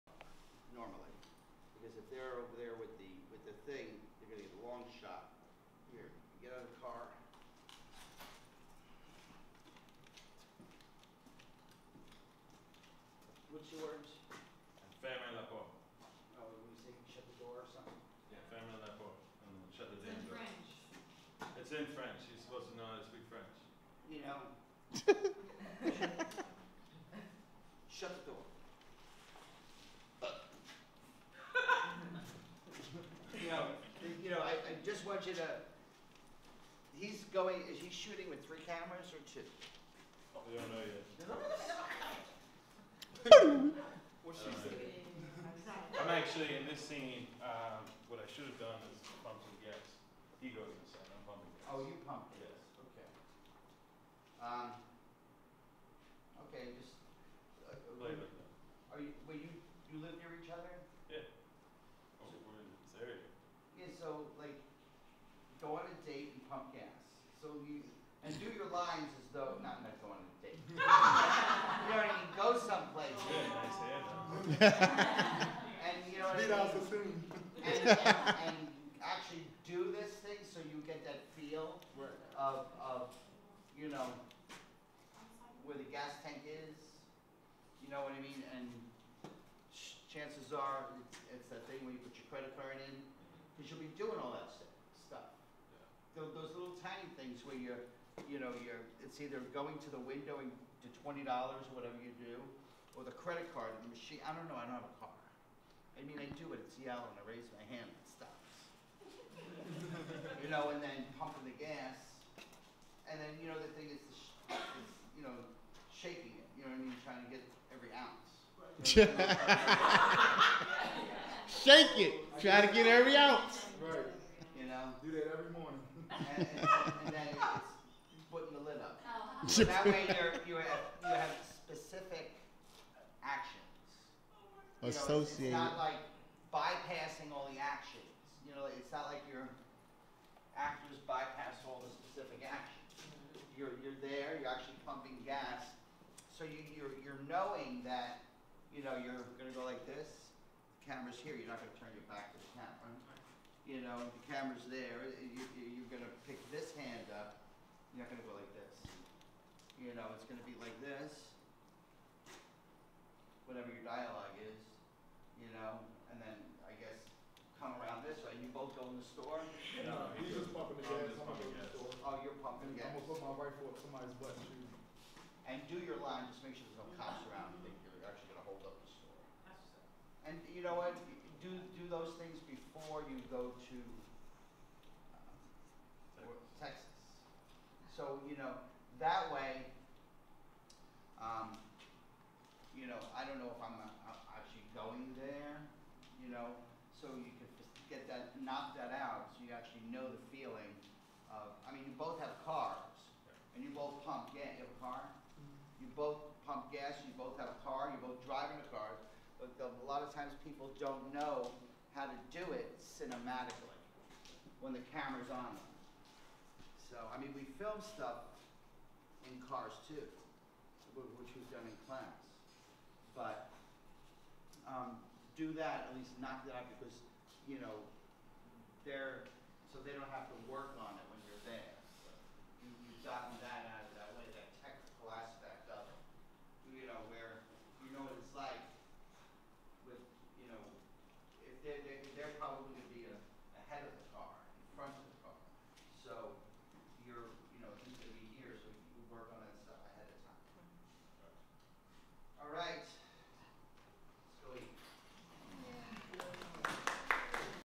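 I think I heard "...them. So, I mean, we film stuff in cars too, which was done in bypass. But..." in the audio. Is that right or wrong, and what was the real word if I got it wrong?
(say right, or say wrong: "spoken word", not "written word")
wrong: "class", not "bypass".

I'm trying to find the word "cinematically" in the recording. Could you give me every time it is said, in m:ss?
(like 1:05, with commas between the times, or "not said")
3:32.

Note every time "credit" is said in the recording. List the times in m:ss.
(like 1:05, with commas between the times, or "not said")
1:32, 1:43.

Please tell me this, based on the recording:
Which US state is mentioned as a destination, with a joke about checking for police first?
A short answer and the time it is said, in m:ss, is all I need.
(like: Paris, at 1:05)
Texas, at 3:06.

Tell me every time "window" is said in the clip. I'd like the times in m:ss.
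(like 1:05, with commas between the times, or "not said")
1:40.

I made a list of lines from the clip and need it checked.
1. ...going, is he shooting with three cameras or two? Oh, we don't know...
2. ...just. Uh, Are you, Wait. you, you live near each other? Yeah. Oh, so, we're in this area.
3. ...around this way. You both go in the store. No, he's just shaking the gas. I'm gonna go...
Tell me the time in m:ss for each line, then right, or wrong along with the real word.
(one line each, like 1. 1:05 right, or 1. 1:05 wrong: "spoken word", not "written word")
1. 0:37 right
2. 0:56 right
3. 2:47 wrong: "pumping", not "shaking".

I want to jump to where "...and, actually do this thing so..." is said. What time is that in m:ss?
1:18.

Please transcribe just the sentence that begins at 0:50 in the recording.
He goes inside, I'm pumping gas.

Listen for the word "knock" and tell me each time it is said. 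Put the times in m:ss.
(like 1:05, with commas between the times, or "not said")
3:18, 3:46.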